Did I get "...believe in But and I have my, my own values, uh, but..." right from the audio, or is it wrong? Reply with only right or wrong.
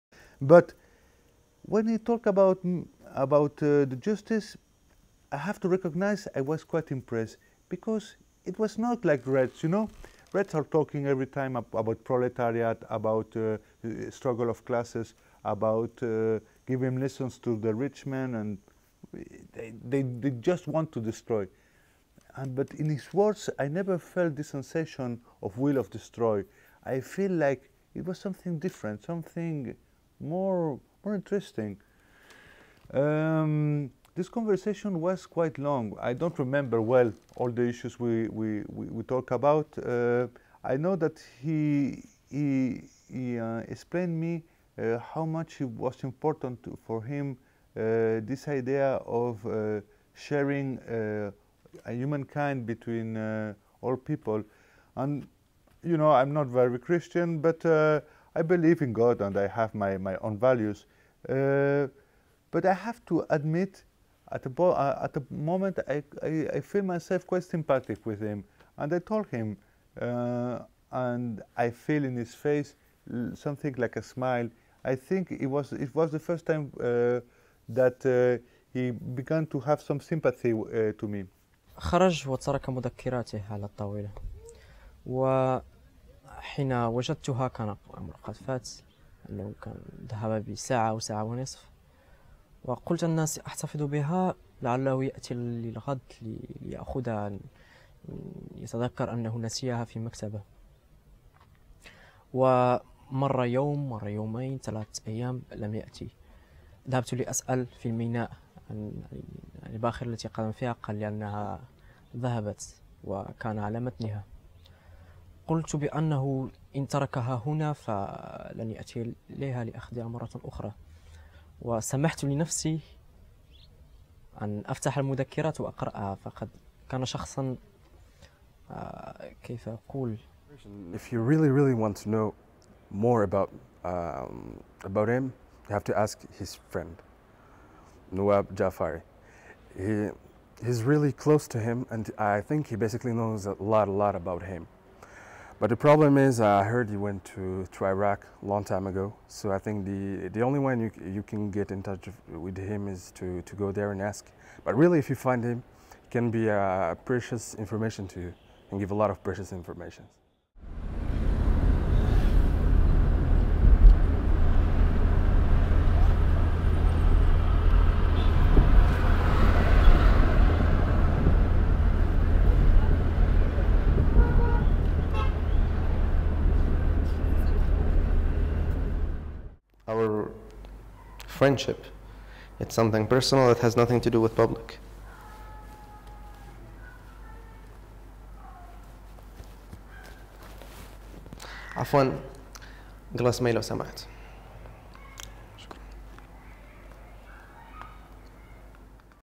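wrong.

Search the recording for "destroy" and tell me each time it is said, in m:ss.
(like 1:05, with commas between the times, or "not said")
0:20, 0:25.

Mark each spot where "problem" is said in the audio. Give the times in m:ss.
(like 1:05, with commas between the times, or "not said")
2:25.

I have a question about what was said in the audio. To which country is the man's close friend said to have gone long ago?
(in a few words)
Iraq.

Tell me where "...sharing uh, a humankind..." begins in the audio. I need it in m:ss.
0:50.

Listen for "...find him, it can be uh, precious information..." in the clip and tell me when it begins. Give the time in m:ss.
2:35.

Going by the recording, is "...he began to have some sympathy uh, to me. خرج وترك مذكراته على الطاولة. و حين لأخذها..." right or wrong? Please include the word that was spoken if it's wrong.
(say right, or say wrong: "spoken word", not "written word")
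wrong: "وجدتها", not "لأخذها".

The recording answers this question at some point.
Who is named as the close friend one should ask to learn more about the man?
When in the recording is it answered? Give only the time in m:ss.
2:18.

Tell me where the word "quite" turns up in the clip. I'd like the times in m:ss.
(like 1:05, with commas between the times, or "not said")
0:06, 0:35, 1:07.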